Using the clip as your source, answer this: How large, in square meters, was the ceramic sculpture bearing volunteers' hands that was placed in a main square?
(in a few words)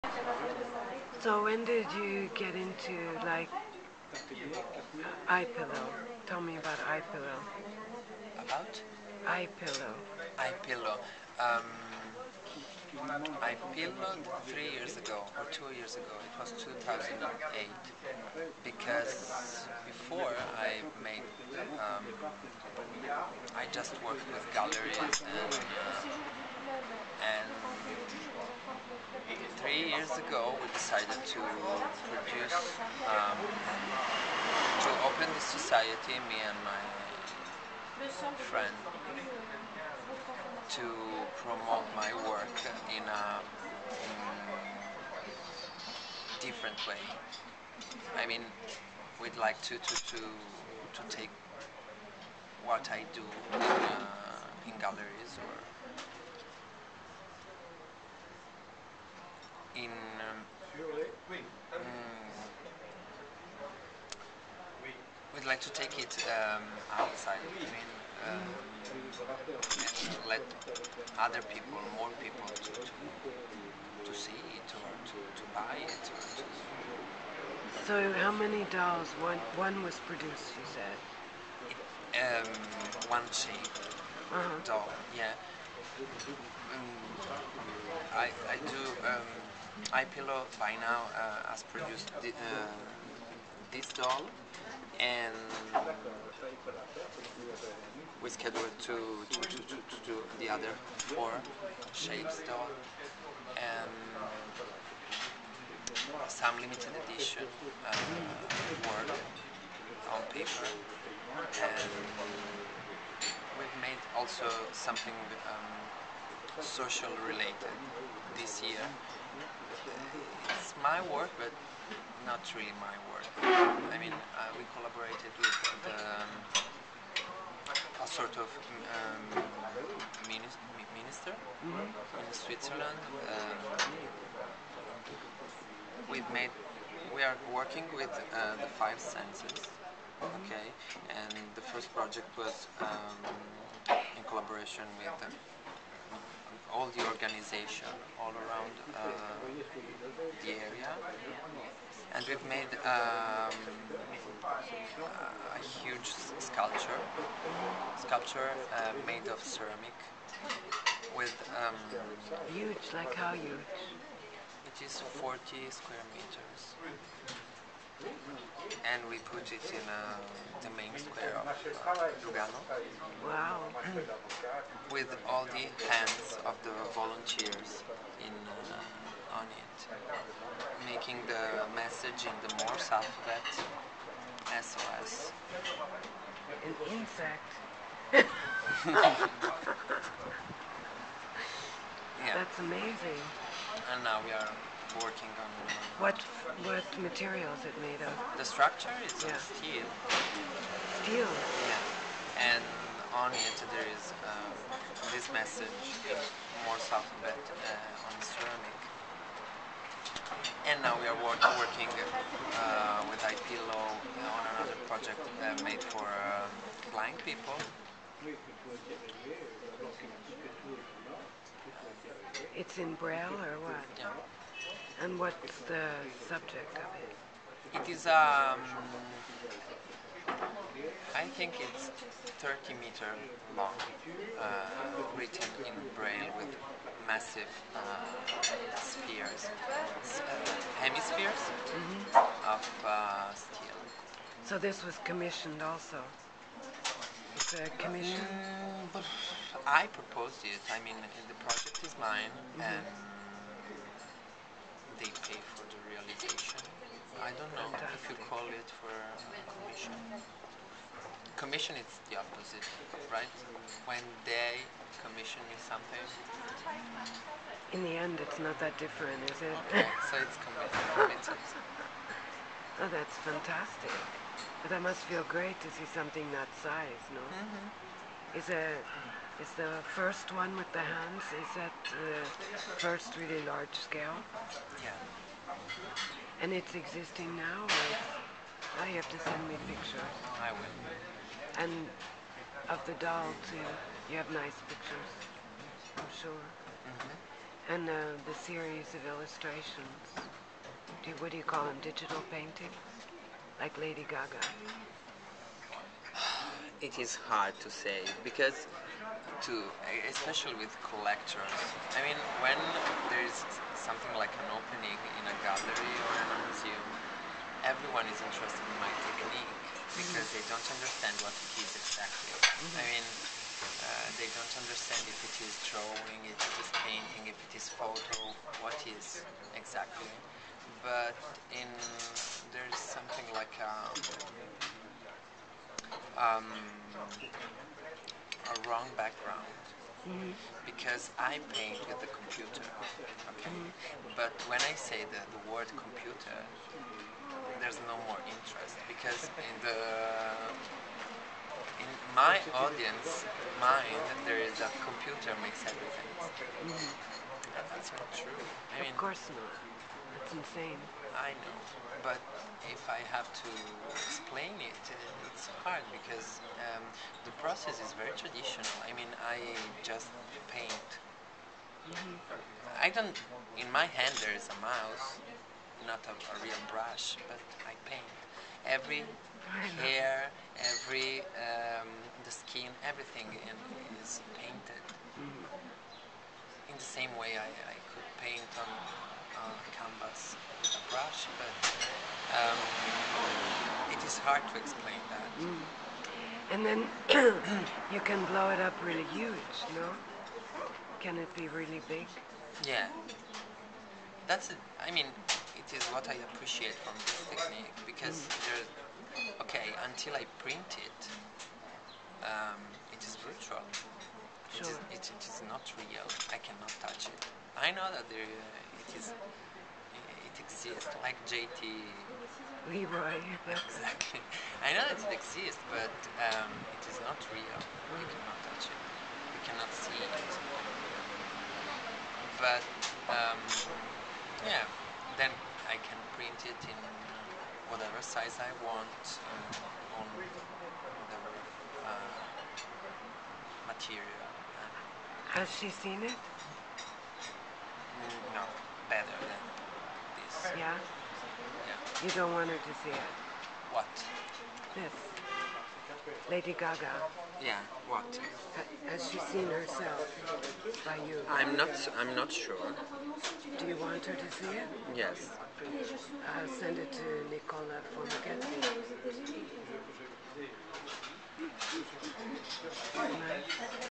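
40 square meters.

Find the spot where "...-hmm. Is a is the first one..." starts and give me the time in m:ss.
4:37.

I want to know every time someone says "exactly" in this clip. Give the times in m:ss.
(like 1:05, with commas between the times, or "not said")
5:21, 5:29, 7:03.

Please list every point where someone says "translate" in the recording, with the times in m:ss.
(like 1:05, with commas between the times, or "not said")
not said.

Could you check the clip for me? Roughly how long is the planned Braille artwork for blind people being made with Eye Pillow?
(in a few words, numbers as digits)
30 meters.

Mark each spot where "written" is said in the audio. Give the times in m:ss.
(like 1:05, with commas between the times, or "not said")
3:55.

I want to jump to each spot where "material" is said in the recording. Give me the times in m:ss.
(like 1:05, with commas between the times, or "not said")
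3:16, 7:23.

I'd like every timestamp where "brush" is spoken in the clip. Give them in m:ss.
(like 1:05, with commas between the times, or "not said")
6:16, 6:30.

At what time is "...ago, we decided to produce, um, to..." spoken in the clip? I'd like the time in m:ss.
0:30.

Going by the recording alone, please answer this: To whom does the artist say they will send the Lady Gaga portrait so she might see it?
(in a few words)
Nicola Formichetti.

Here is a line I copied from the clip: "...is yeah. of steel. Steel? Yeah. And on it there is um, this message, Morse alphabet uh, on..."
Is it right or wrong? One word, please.
right.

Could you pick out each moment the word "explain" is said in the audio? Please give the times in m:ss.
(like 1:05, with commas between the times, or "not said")
6:03, 6:34.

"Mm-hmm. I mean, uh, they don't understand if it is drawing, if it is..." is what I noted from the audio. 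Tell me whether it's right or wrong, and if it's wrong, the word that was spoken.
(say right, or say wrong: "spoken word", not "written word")
right.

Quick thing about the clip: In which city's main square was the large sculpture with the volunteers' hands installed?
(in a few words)
Lugano.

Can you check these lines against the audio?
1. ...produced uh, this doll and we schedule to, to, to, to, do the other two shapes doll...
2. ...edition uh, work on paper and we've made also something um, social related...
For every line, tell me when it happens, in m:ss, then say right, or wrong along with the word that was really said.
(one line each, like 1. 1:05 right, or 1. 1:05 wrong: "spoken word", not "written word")
1. 1:31 wrong: "four", not "two"
2. 1:47 right.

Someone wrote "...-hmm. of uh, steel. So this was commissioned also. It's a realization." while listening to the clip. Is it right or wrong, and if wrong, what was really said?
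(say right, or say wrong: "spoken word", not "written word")
wrong: "commission", not "realization".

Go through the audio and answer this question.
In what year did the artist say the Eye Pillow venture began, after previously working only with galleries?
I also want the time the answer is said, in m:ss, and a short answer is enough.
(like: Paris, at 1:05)
2008, at 0:16.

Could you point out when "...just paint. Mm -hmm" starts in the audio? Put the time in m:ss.
6:09.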